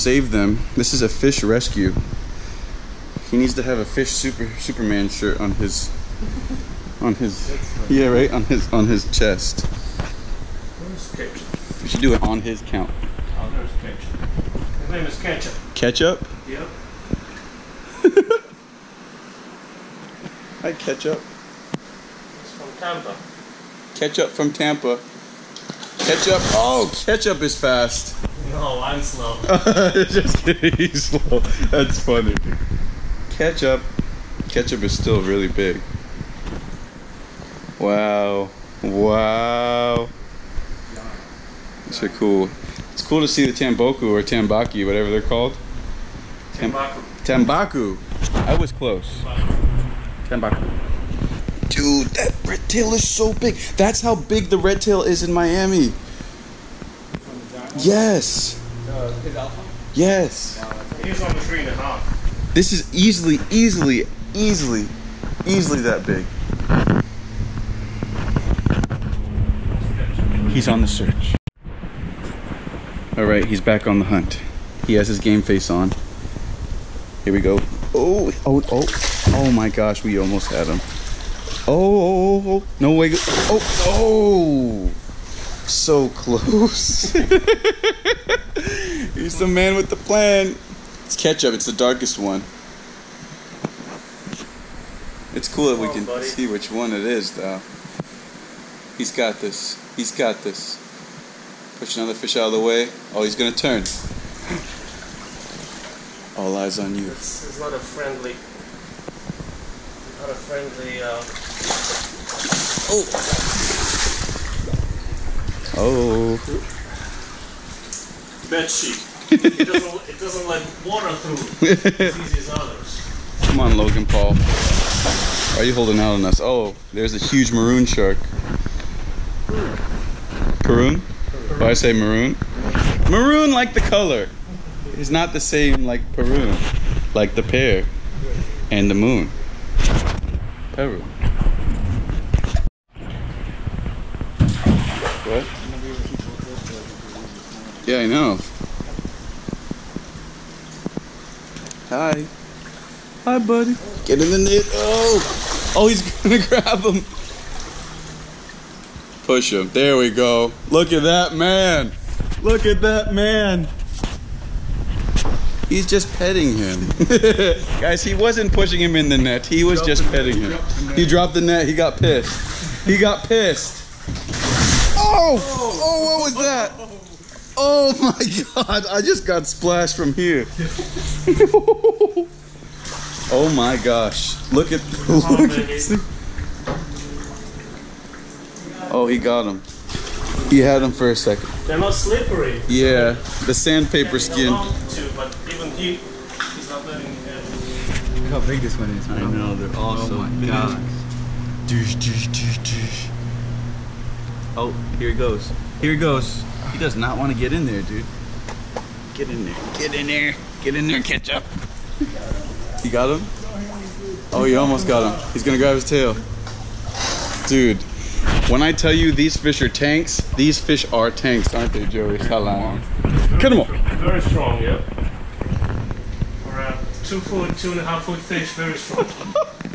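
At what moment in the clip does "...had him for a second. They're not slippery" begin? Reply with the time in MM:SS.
03:10.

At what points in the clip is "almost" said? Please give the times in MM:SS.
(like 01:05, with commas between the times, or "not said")
01:20, 03:34.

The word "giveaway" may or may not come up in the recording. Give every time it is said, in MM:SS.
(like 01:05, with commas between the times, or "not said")
not said.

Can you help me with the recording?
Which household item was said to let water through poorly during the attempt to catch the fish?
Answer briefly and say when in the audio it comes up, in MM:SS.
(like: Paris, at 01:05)
Bed sheet, at 01:58.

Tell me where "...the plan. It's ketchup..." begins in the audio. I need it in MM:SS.
01:29.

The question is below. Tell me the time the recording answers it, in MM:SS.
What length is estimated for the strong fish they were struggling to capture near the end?
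03:47.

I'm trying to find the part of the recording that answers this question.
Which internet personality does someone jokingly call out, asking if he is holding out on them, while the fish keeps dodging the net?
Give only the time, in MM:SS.
02:03.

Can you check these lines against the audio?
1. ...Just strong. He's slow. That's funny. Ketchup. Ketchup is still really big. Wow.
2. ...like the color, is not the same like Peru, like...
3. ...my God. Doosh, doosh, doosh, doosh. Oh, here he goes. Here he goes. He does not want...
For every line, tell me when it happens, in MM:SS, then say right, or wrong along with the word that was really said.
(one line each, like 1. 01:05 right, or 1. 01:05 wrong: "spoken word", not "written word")
1. 00:30 wrong: "kidding", not "strong"
2. 02:13 right
3. 03:20 right.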